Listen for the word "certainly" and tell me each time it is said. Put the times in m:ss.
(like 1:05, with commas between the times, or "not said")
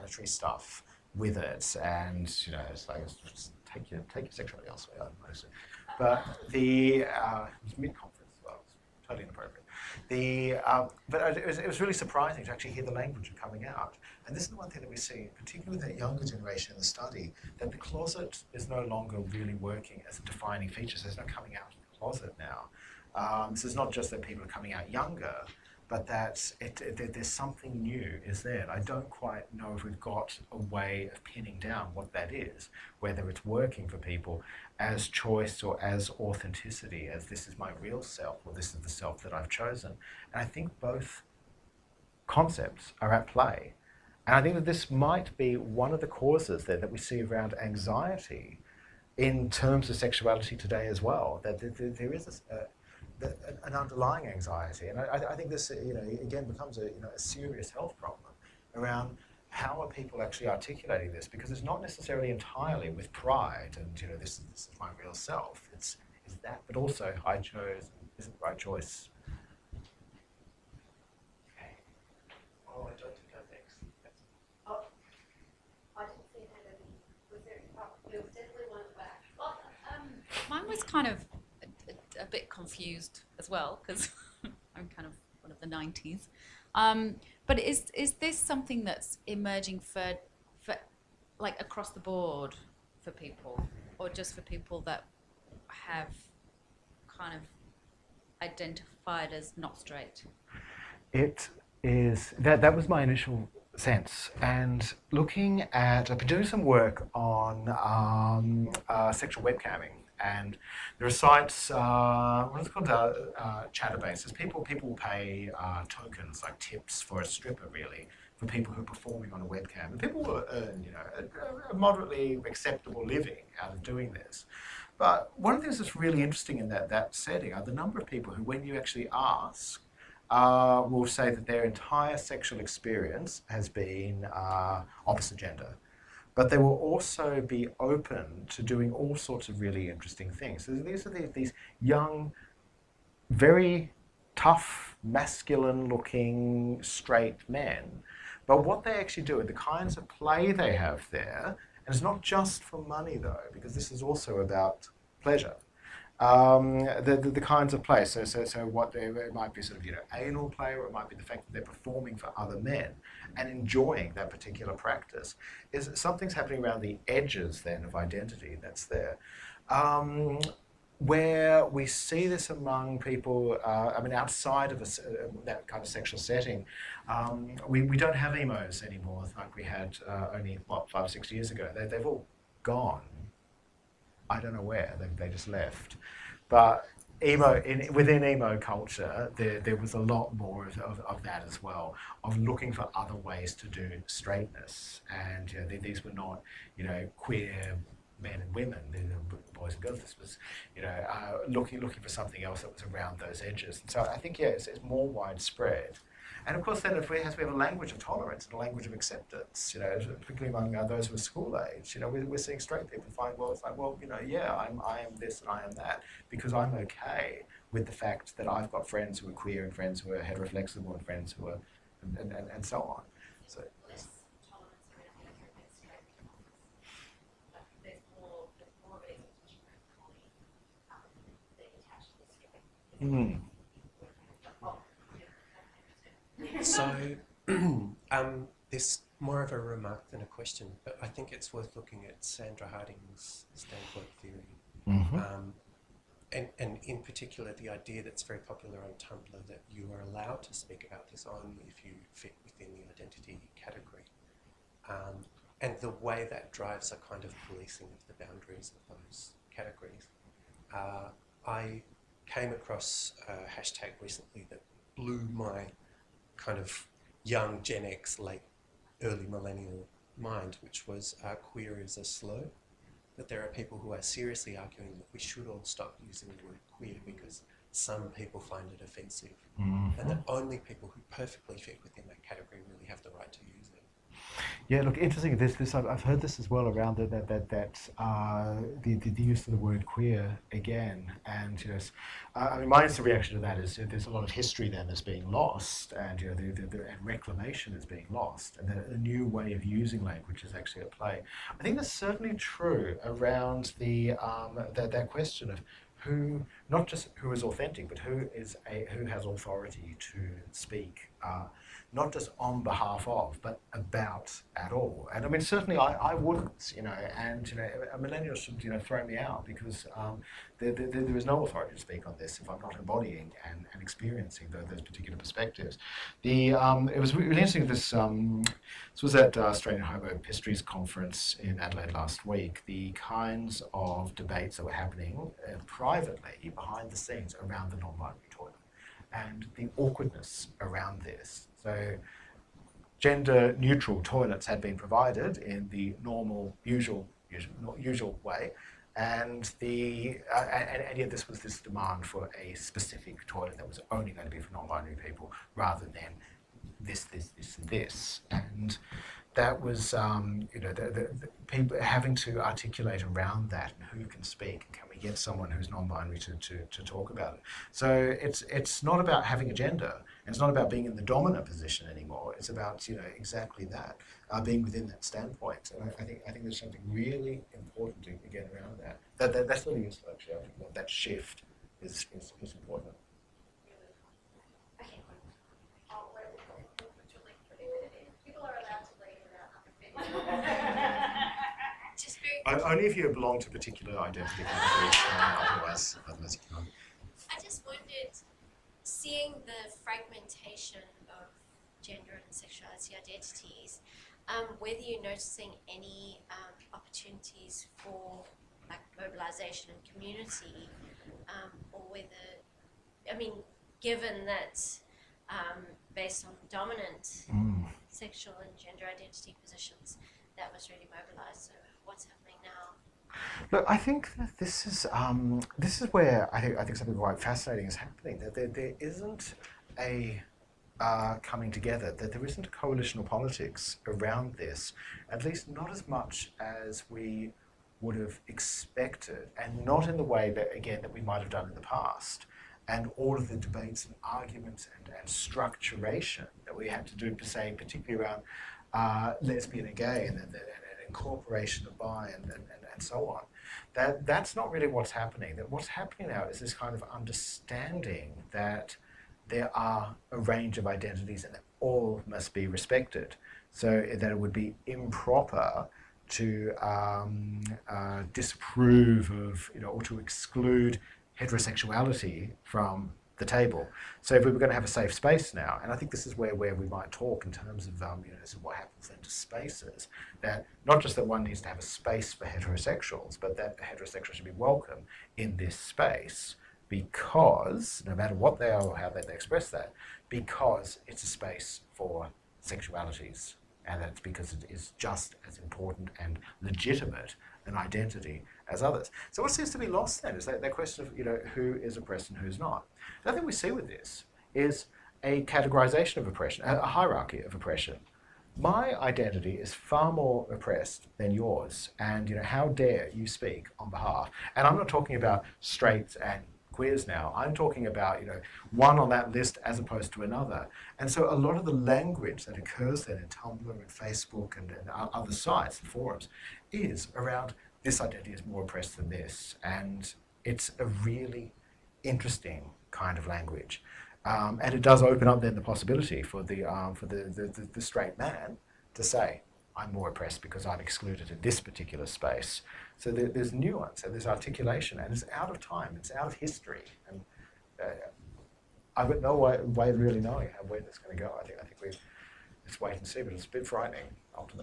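5:01, 5:15.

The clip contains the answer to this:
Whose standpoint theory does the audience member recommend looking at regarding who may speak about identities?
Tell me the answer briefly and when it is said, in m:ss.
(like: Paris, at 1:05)
Sandra Harding, at 4:02.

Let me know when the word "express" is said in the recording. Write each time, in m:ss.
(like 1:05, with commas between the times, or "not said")
8:09.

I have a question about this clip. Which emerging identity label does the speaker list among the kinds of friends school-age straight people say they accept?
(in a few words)
Heteroflexible.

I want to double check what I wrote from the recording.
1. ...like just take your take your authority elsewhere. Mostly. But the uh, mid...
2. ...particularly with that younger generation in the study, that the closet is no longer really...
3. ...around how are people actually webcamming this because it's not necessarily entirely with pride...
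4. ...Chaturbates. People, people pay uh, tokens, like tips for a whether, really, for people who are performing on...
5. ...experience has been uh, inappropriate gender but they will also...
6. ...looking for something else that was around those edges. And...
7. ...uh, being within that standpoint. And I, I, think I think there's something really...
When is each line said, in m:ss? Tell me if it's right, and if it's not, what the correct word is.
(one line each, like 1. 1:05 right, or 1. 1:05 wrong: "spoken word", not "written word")
1. 0:02 wrong: "sexuality", not "authority"
2. 0:15 right
3. 0:58 wrong: "articulating", not "webcamming"
4. 1:53 wrong: "stripper", not "whether"
5. 2:12 wrong: "opposite", not "inappropriate"
6. 3:21 right
7. 6:14 right.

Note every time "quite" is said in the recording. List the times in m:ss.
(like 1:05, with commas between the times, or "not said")
0:29, 7:06.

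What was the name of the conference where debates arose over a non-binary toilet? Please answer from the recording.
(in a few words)
Australian Homo Histories Conference.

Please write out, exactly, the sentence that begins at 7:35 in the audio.
That what's happening now is this kind of understanding that there are a range of identities and all must be respected.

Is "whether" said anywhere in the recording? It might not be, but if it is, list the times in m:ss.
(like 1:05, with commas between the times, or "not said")
0:32, 6:44, 6:51.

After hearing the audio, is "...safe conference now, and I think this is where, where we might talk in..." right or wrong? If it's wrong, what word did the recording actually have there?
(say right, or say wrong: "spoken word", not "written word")
wrong: "space", not "conference".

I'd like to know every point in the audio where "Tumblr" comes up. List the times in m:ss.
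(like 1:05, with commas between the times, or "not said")
4:08, 8:43.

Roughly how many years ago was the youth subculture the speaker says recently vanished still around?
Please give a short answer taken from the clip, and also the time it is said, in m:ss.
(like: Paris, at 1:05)
5 or 6 years, at 3:00.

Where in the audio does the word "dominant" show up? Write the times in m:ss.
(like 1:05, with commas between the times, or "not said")
6:11, 6:56.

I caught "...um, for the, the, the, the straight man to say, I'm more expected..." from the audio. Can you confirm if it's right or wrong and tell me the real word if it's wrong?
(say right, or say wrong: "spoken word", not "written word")
wrong: "oppressed", not "expected".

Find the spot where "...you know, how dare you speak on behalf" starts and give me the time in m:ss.
8:32.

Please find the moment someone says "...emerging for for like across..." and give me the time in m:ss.
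1:29.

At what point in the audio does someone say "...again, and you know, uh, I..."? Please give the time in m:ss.
4:50.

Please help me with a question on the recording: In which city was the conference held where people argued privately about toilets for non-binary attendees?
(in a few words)
Adelaide.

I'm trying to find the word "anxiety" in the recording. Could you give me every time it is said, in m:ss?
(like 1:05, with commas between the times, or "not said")
0:47, 0:54.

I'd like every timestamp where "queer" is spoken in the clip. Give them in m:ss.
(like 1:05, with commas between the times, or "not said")
3:17, 3:39, 4:31, 4:36, 4:49, 8:36.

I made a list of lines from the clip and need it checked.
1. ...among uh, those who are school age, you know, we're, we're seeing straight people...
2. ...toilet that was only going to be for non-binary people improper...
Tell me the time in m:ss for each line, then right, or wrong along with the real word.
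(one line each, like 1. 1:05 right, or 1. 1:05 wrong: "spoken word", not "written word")
1. 3:30 right
2. 5:53 wrong: "rather", not "improper".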